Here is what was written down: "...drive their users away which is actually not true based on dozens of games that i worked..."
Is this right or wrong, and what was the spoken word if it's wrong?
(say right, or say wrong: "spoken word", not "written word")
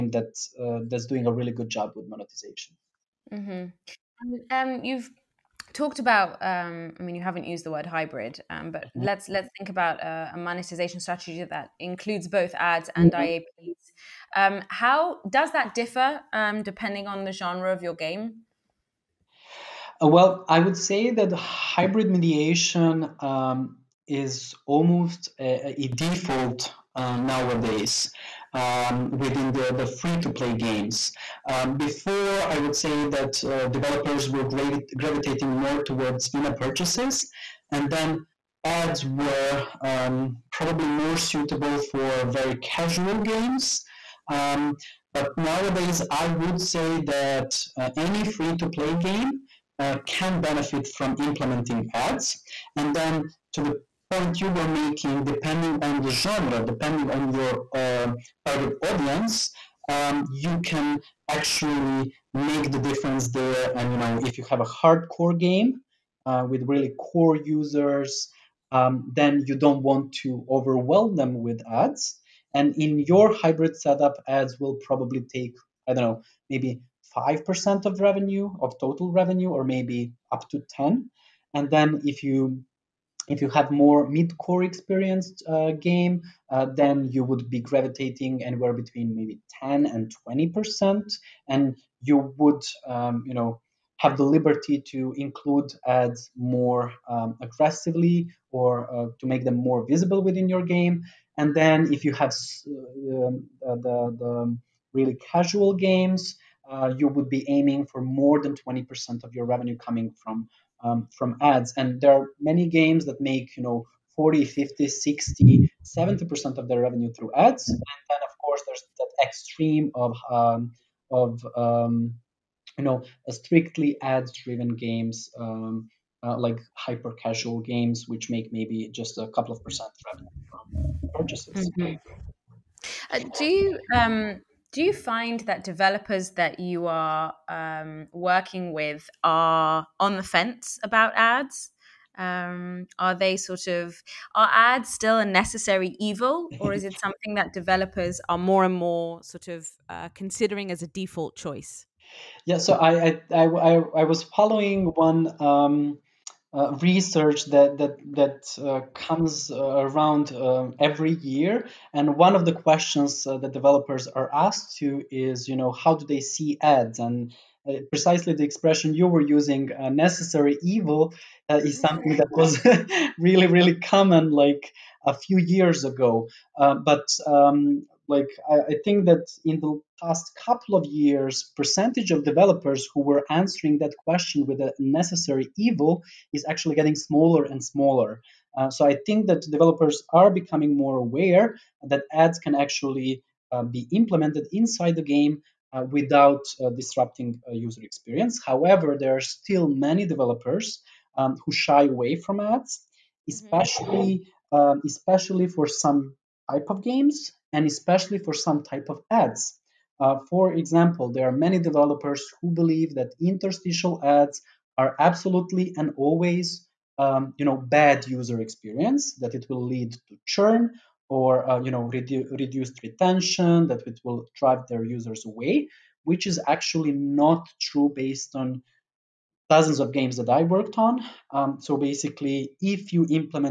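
right.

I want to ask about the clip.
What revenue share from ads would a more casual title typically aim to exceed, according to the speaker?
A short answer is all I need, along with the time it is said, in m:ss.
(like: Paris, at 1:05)
more than 20%, at 1:48.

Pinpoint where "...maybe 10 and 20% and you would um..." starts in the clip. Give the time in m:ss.
1:29.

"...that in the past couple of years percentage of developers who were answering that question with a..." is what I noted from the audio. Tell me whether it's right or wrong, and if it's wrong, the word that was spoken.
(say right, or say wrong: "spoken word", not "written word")
right.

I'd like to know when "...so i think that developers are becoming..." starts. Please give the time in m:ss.
3:08.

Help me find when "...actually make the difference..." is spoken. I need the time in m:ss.
1:01.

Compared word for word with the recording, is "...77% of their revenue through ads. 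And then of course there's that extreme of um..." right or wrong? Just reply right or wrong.
wrong.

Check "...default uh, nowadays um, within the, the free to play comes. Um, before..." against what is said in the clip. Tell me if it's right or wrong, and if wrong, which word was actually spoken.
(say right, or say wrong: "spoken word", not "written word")
wrong: "games", not "comes".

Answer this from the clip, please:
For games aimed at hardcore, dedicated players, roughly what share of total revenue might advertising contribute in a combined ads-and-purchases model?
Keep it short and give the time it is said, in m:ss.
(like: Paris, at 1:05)
5%, at 1:17.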